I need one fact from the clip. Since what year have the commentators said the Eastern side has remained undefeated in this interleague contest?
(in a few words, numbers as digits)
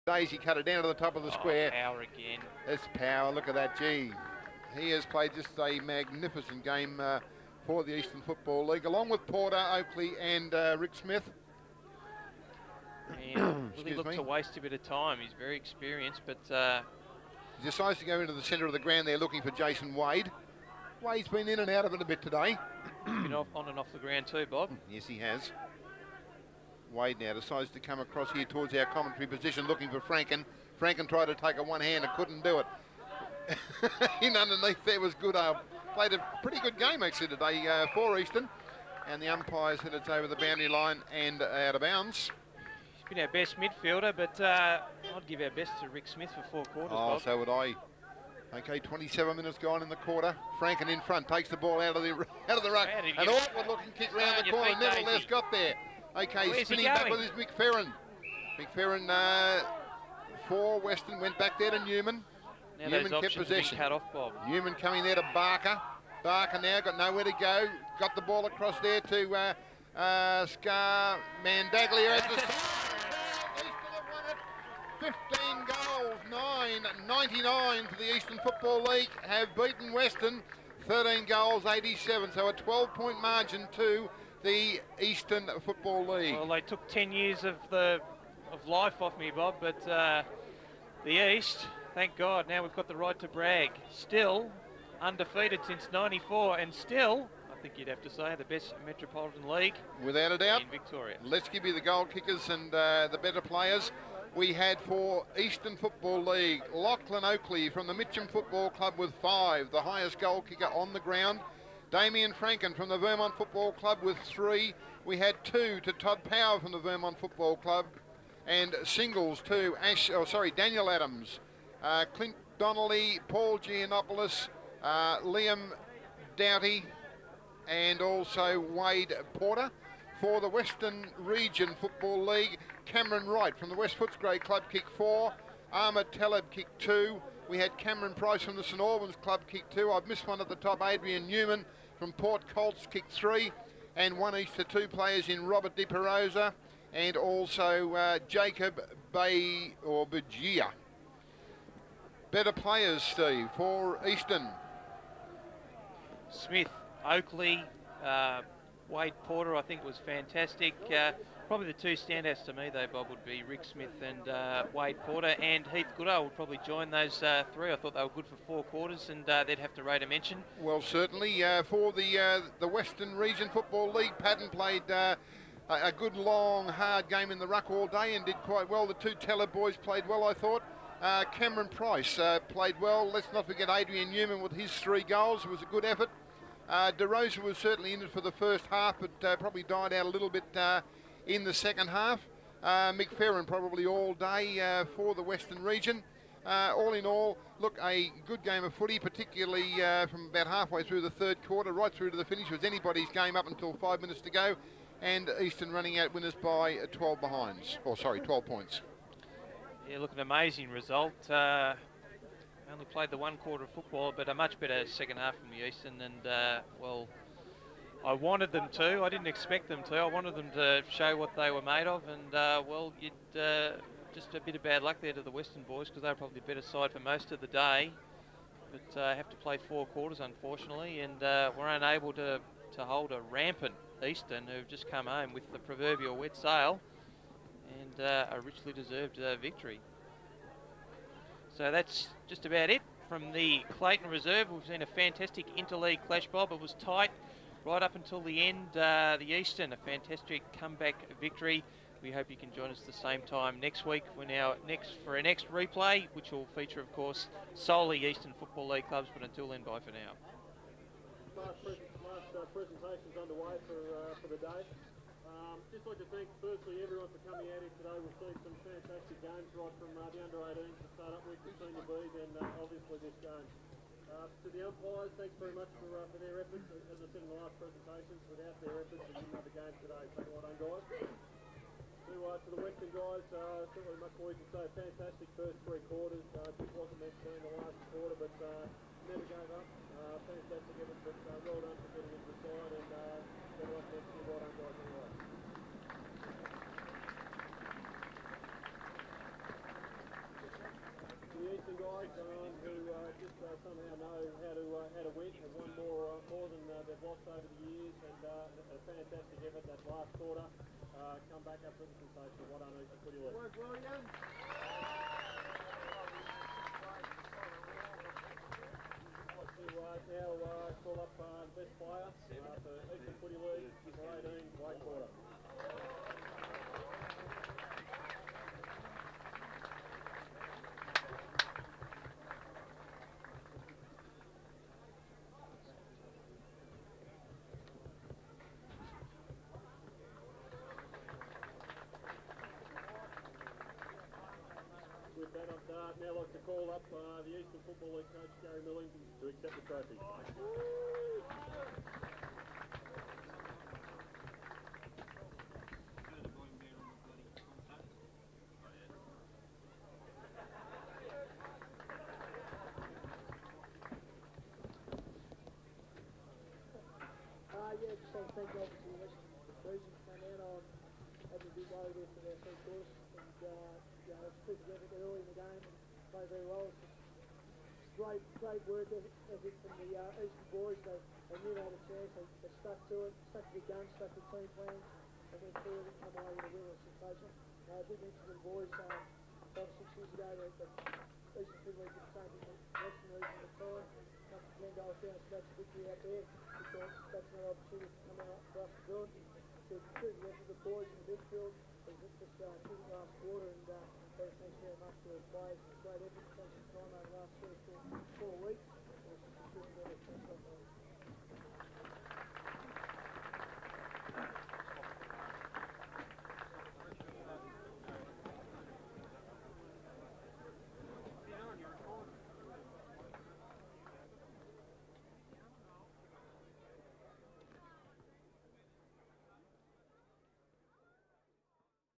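1994.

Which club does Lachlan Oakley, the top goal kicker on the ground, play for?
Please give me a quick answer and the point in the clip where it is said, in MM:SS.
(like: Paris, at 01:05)
Mitcham Football Club, at 01:47.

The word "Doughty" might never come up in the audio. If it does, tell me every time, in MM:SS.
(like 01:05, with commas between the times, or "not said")
02:06.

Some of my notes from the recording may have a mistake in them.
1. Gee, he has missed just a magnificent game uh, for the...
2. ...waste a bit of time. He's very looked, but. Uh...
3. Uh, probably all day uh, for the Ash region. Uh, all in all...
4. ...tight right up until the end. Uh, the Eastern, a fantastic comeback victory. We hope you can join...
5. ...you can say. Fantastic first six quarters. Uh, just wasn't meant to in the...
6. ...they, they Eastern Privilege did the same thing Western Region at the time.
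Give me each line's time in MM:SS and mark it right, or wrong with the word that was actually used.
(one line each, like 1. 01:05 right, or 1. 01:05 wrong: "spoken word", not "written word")
1. 00:03 wrong: "played", not "missed"
2. 00:14 wrong: "experienced", not "looked"
3. 03:12 wrong: "Western", not "Ash"
4. 04:06 right
5. 04:44 wrong: "three", not "six"
6. 06:30 right.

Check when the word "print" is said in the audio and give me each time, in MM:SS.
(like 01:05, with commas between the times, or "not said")
not said.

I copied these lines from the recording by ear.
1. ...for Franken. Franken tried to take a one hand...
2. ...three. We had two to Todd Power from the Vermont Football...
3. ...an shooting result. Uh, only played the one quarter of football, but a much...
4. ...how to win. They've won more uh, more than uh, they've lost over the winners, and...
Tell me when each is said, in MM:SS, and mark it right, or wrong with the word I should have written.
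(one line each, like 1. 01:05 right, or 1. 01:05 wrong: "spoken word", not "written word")
1. 00:29 right
2. 01:54 right
3. 03:30 wrong: "amazing", not "shooting"
4. 05:04 wrong: "years", not "winners".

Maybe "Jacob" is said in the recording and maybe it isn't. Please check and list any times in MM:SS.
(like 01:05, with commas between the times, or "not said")
02:28.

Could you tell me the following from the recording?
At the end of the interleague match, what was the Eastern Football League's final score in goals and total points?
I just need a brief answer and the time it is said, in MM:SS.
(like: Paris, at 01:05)
15 goals, 99, at 01:14.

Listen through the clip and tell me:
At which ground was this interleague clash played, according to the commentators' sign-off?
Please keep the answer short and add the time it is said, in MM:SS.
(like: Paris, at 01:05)
Clayton Reserve, at 04:03.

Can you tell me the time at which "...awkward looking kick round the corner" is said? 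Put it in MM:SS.
00:53.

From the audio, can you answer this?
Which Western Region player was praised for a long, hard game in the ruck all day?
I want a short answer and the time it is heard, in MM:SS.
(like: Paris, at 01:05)
Padden, at 02:54.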